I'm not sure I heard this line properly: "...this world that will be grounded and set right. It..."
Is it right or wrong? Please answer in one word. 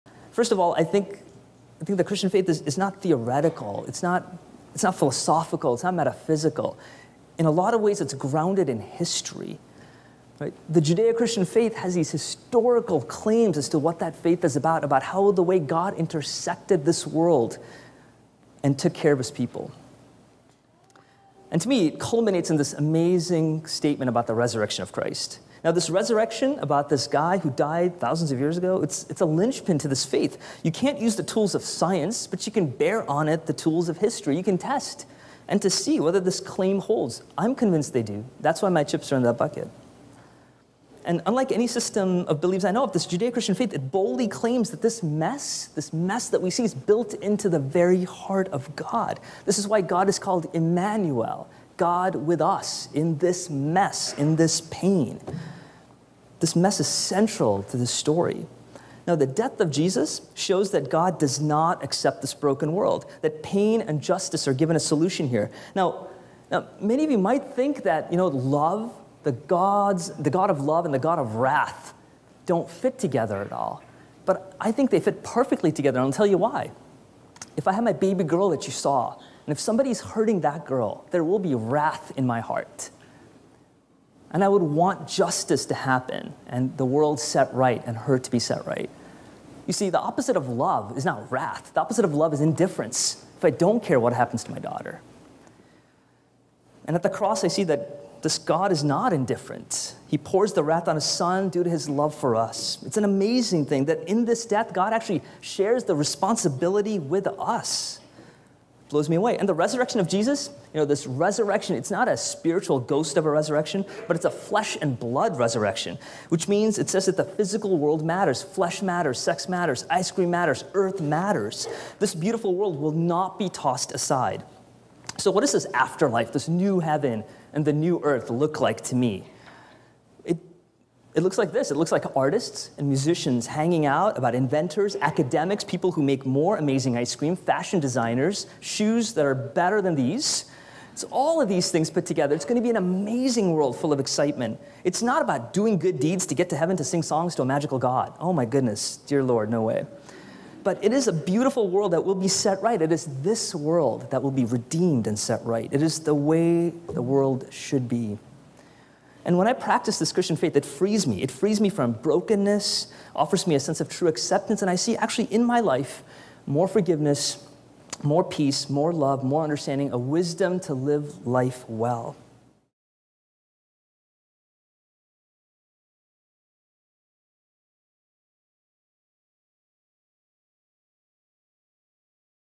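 wrong.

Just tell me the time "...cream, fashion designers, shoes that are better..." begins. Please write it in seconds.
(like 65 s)
137 s.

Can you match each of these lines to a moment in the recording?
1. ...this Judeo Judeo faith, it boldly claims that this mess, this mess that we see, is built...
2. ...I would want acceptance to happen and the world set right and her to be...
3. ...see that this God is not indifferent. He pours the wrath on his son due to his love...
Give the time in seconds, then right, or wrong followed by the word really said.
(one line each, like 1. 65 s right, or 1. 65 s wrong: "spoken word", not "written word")
1. 42 s wrong: "Christian", not "Judeo"
2. 84 s wrong: "justice", not "acceptance"
3. 97 s right.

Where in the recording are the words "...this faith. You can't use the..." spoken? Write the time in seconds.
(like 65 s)
29 s.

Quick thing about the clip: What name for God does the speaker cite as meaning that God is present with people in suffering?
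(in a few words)
Emmanuel.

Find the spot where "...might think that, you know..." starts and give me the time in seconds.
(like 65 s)
67 s.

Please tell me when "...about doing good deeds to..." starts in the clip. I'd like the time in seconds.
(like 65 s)
145 s.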